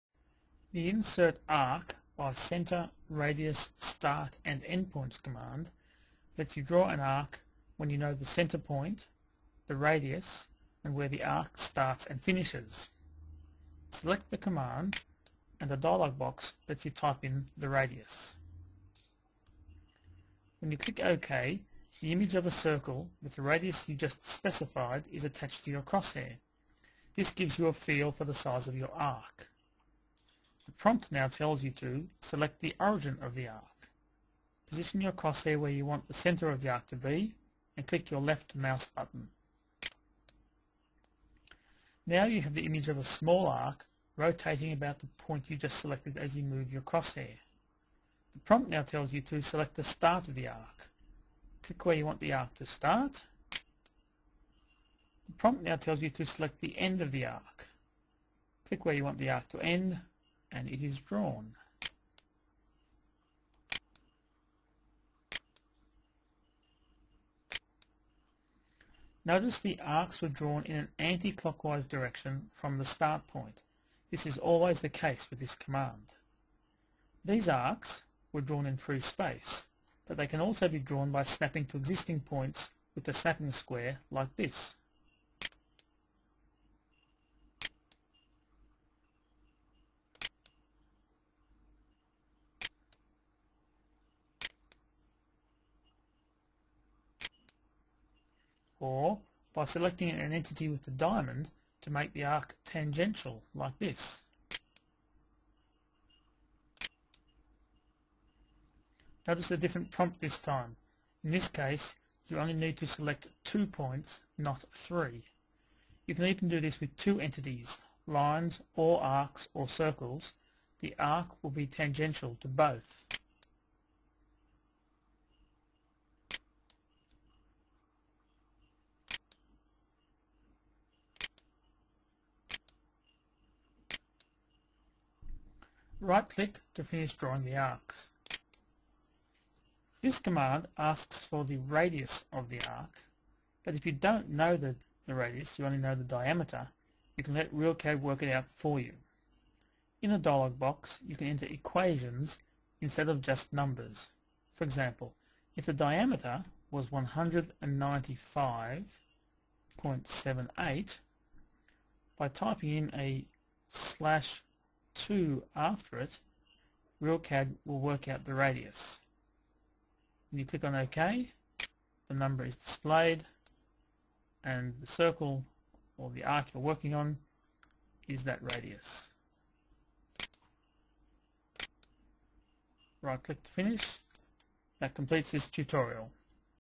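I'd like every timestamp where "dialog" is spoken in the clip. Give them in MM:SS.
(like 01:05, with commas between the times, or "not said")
00:15, 02:30.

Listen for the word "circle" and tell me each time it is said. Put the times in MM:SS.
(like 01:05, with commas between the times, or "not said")
00:22, 01:59, 02:54.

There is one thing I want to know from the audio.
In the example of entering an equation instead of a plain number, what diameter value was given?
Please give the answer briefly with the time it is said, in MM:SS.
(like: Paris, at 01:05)
195.78, at 02:36.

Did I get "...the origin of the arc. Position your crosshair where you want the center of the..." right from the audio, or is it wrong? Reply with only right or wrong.
right.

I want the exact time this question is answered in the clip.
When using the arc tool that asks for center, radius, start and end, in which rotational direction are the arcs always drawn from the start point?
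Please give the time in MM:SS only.
01:10.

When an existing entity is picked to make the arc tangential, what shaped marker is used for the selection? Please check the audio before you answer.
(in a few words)
diamond.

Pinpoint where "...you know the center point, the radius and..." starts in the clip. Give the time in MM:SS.
00:07.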